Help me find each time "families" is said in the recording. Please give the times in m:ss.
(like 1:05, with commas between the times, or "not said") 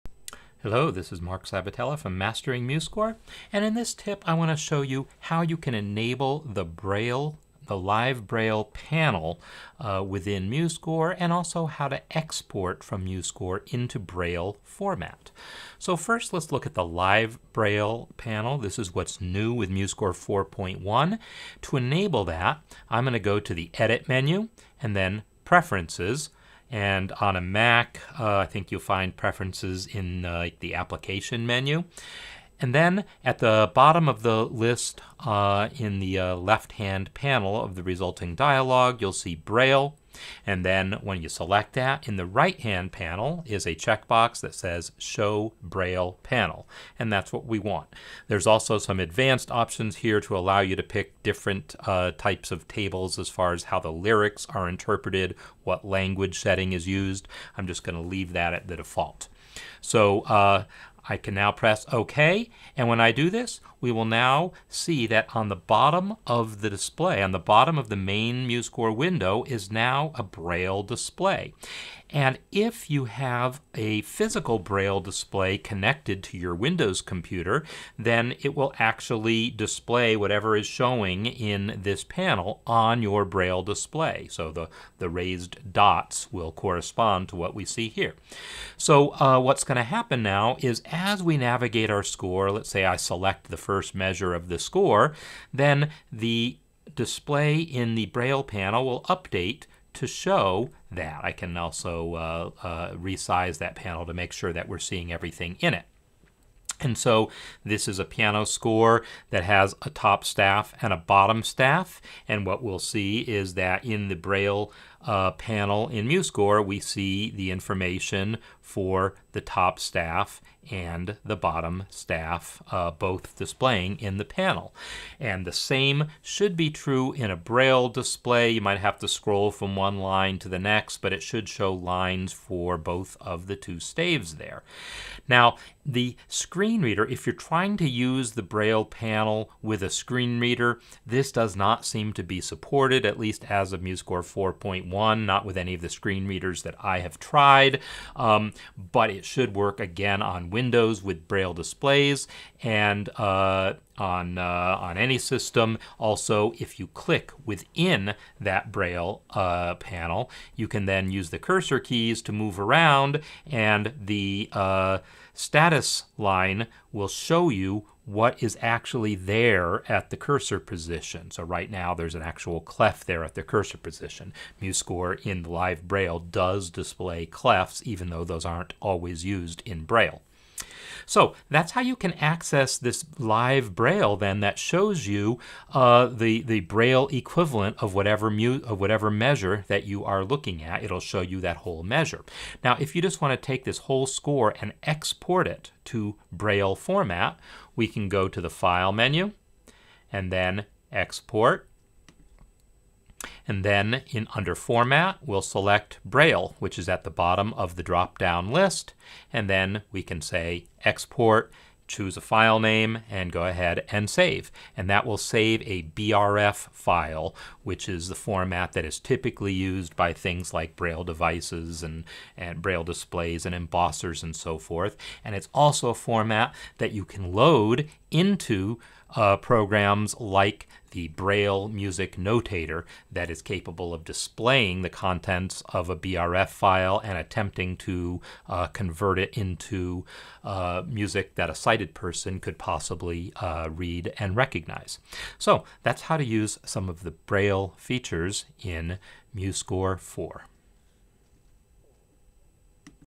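not said.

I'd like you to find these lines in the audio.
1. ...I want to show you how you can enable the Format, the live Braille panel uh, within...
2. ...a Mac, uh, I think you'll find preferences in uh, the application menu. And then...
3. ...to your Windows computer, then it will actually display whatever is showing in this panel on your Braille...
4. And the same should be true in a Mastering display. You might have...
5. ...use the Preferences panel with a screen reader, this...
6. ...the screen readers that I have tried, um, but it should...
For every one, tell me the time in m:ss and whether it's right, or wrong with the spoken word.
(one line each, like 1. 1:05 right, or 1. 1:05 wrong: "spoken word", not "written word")
1. 0:04 wrong: "Braille", not "Format"
2. 0:27 right
3. 1:16 right
4. 2:05 wrong: "Braille", not "Mastering"
5. 2:17 wrong: "Braille", not "Preferences"
6. 2:25 right.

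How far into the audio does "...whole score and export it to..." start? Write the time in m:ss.
3:13.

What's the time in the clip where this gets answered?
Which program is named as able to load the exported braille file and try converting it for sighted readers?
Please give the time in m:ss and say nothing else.
3:51.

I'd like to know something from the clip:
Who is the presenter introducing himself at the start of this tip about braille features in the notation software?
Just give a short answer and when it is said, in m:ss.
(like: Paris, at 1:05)
Mark Sabatella, at 0:01.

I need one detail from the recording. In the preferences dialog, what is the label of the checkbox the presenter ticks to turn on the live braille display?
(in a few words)
Show Braille Panel.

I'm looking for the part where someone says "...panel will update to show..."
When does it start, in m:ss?
1:38.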